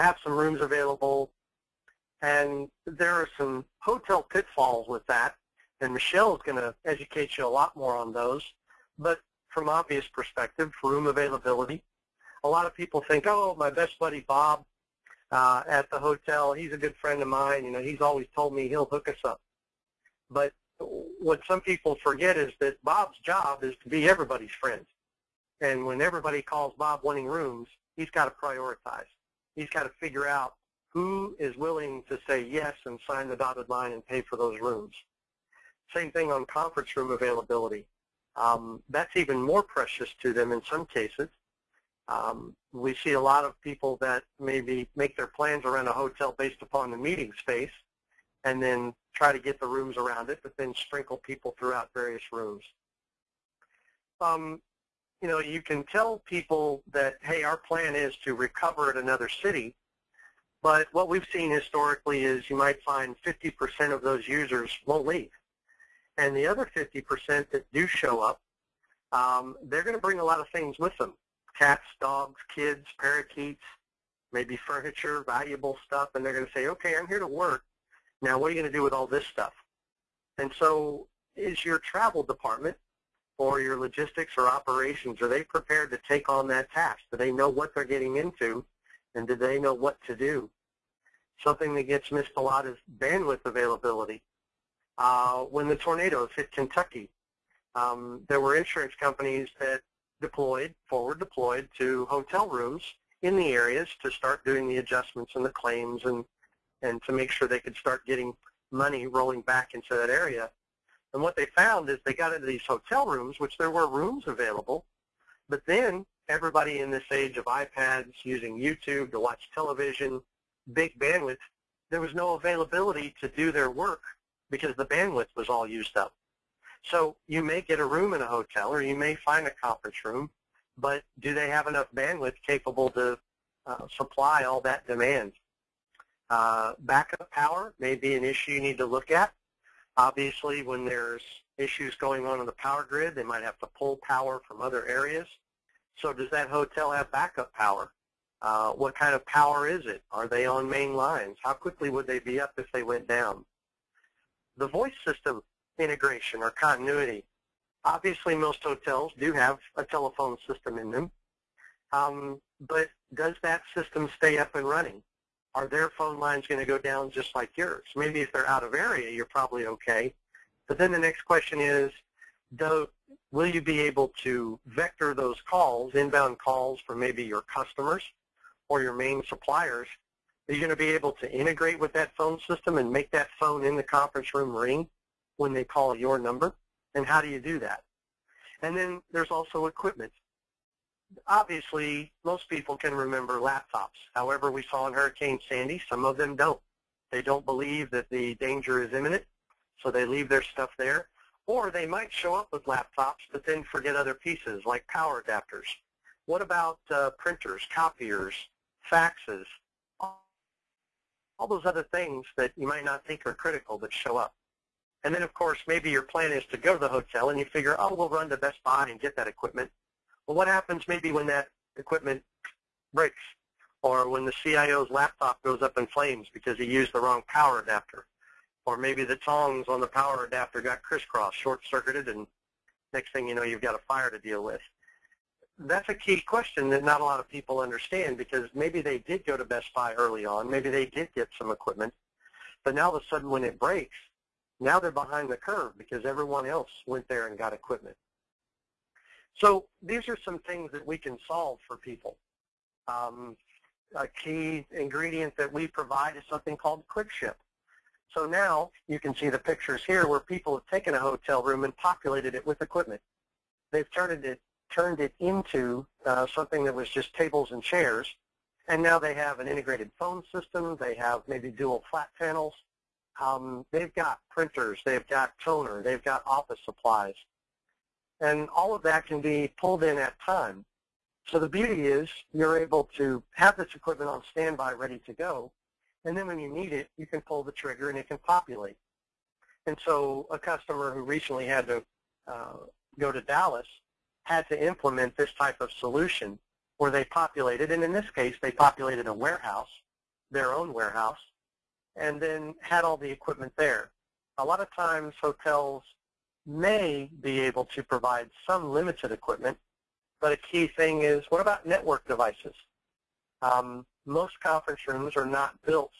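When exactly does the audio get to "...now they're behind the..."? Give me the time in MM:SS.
04:04.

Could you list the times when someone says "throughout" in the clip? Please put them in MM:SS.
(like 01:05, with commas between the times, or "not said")
00:51.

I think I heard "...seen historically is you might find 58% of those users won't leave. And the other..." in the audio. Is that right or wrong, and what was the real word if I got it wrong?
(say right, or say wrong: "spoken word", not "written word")
wrong: "50", not "58".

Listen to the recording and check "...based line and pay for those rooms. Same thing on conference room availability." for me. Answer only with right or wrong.
wrong.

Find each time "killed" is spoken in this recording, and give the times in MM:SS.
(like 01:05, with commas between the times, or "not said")
not said.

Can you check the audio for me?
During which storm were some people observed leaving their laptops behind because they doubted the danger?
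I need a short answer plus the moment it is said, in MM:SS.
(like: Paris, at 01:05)
Hurricane Sandy, at 03:14.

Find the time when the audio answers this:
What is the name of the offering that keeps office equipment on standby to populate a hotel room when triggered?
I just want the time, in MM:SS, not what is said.
04:16.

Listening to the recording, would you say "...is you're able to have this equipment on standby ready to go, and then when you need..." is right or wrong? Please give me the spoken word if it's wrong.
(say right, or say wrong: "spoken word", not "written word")
right.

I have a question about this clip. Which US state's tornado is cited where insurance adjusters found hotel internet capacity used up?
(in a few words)
Kentucky.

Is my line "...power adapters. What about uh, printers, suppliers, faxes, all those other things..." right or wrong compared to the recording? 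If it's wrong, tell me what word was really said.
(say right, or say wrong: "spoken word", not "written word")
wrong: "copiers", not "suppliers".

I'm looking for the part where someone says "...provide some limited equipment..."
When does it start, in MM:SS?
05:07.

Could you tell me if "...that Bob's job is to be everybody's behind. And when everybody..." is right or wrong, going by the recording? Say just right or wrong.
wrong.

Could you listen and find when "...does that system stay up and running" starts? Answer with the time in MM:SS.
02:43.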